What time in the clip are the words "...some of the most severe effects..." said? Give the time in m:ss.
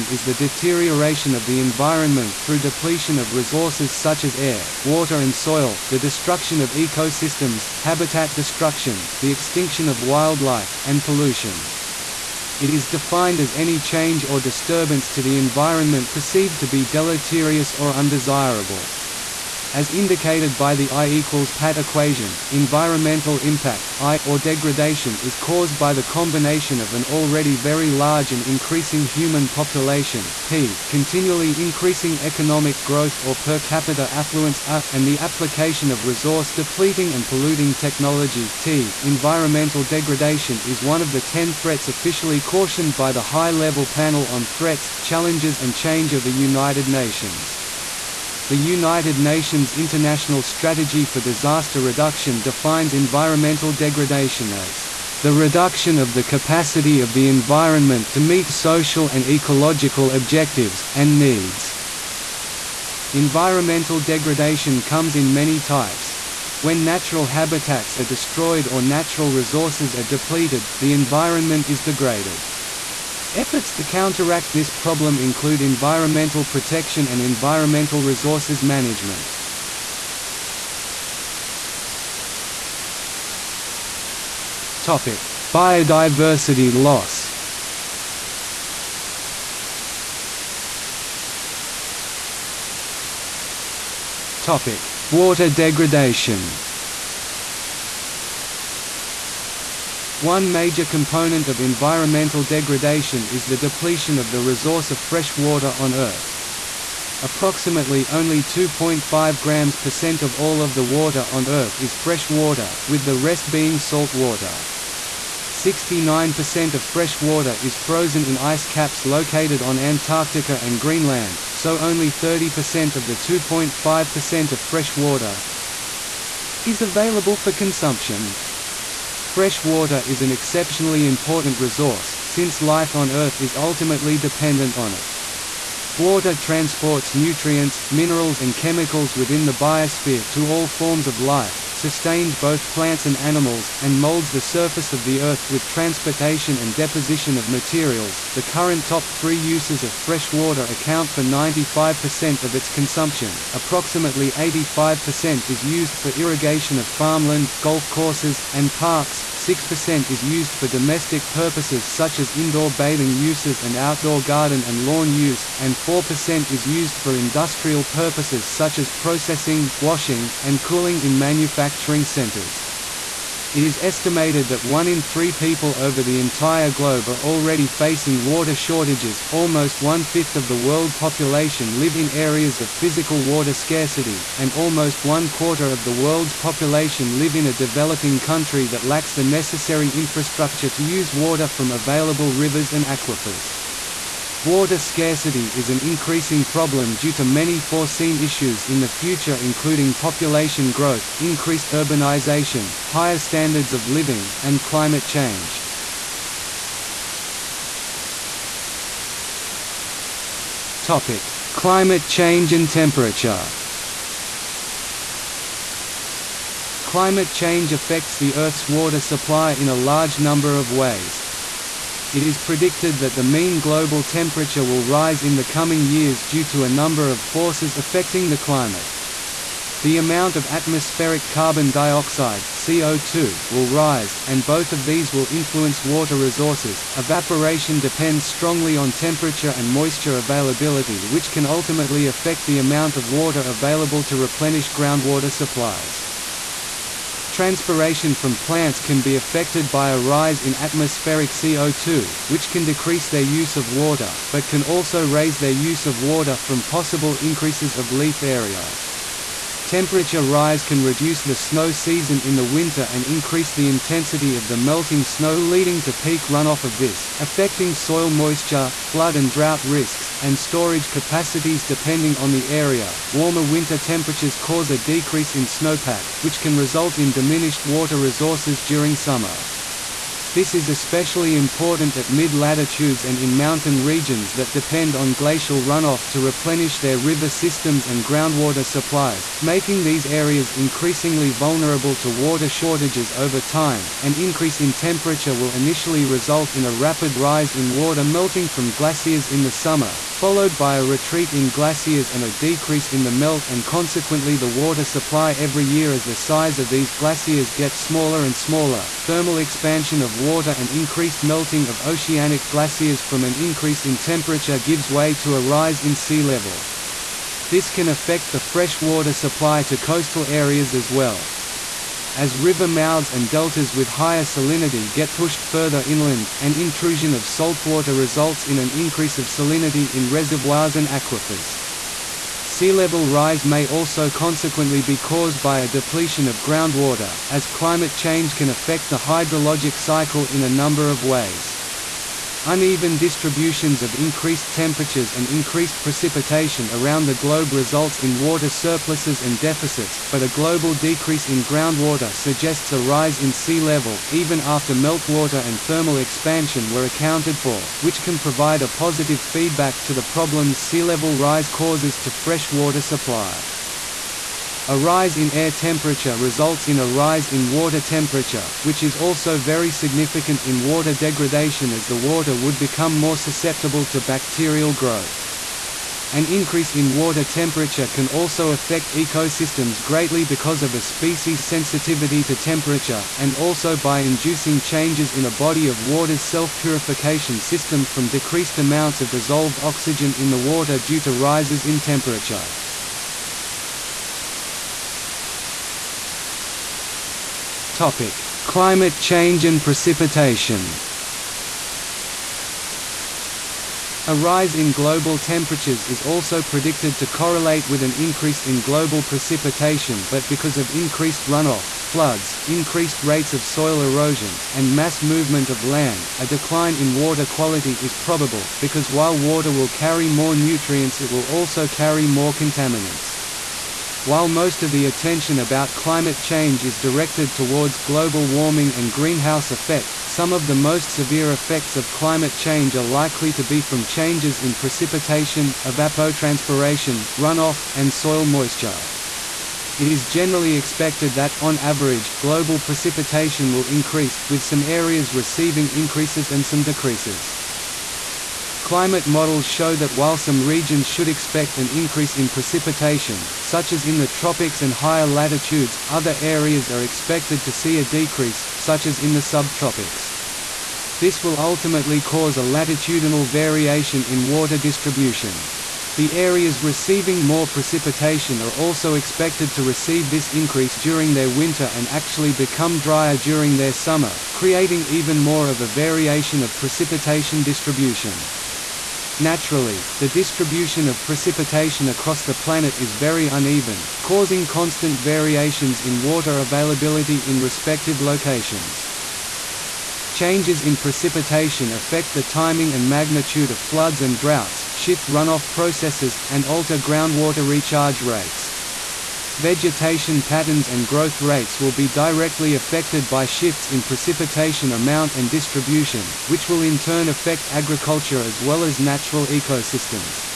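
7:10.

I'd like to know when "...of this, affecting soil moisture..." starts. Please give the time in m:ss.
4:26.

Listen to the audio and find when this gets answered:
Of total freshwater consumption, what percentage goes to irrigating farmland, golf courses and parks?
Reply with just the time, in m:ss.
2:34.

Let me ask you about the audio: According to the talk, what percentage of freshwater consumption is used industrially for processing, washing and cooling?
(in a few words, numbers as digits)
4%.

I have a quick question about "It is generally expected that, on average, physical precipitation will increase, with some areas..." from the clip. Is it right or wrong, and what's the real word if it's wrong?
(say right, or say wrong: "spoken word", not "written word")
wrong: "global", not "physical".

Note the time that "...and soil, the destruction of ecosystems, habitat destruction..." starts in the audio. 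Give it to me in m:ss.
0:05.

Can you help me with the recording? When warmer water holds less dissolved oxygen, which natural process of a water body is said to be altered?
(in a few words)
self-purification system.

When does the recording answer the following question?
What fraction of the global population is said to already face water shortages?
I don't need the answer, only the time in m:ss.
2:54.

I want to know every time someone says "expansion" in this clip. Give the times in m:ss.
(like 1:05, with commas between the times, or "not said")
5:09, 5:55.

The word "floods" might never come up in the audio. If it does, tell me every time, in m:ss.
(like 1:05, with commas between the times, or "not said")
4:28, 6:51, 8:13.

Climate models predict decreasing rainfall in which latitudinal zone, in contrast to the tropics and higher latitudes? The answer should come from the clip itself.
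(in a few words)
the subtropics.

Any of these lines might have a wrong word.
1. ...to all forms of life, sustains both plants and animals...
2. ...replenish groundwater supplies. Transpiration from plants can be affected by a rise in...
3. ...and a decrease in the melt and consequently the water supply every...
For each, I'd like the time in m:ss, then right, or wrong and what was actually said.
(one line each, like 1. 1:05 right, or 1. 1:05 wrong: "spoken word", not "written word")
1. 2:20 right
2. 4:04 right
3. 5:02 right.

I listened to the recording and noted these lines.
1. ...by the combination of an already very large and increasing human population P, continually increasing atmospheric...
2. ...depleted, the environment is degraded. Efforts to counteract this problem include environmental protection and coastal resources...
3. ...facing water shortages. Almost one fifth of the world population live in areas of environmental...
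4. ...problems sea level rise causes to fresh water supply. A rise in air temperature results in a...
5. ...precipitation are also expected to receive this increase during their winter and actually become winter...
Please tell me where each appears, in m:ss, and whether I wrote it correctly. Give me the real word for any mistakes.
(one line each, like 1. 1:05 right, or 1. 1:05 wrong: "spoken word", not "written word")
1. 0:25 wrong: "economic", not "atmospheric"
2. 1:10 wrong: "environmental", not "coastal"
3. 2:57 wrong: "physical", not "environmental"
4. 6:00 right
5. 7:47 wrong: "drier", not "winter".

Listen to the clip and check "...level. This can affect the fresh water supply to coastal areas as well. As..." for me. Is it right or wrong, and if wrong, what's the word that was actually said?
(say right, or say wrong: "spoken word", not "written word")
right.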